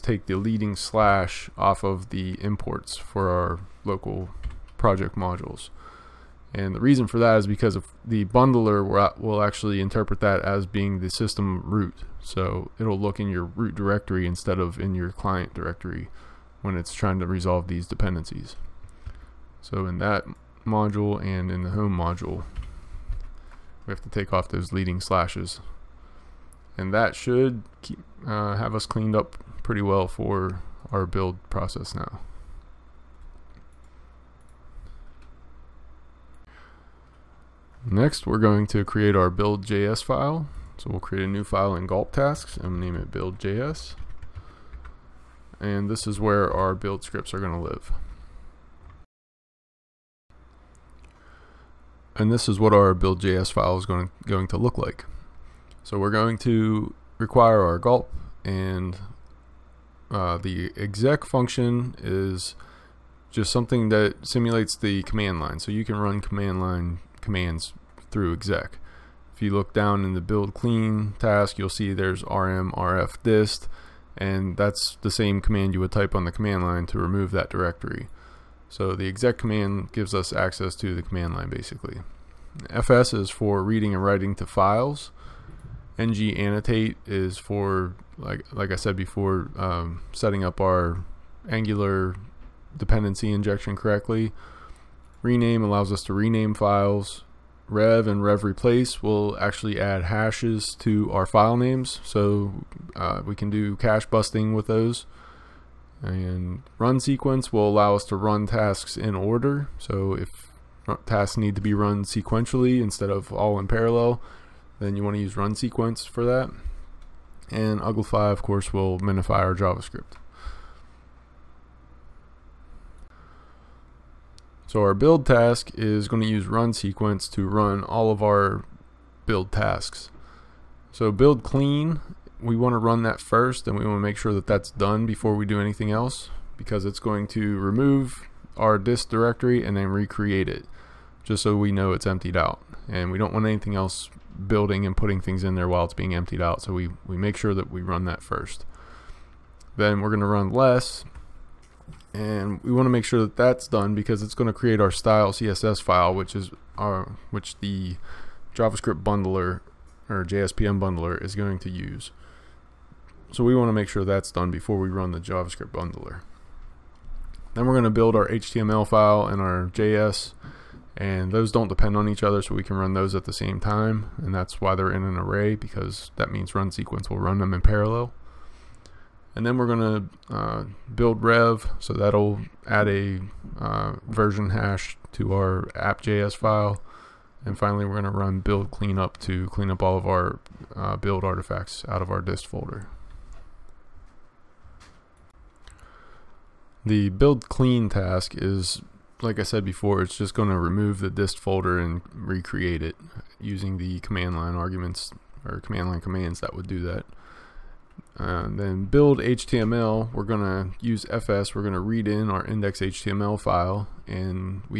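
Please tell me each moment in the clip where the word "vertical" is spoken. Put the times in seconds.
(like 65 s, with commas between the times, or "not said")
not said.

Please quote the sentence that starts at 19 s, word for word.
So in that module and in the home module.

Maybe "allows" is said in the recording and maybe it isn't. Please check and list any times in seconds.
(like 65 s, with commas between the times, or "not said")
95 s, 107 s.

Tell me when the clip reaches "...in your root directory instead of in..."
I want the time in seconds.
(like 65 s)
13 s.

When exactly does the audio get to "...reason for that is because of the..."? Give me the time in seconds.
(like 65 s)
6 s.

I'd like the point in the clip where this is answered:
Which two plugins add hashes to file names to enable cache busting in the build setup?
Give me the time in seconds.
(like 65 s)
97 s.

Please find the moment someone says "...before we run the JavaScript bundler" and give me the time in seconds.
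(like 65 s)
164 s.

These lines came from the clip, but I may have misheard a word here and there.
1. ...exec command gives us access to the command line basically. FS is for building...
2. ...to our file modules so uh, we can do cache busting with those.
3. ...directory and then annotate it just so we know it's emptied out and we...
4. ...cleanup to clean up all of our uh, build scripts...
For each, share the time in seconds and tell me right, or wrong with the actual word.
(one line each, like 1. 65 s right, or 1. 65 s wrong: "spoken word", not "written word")
1. 79 s wrong: "reading", not "building"
2. 100 s wrong: "names", not "modules"
3. 139 s wrong: "recreate", not "annotate"
4. 188 s wrong: "artifacts", not "scripts".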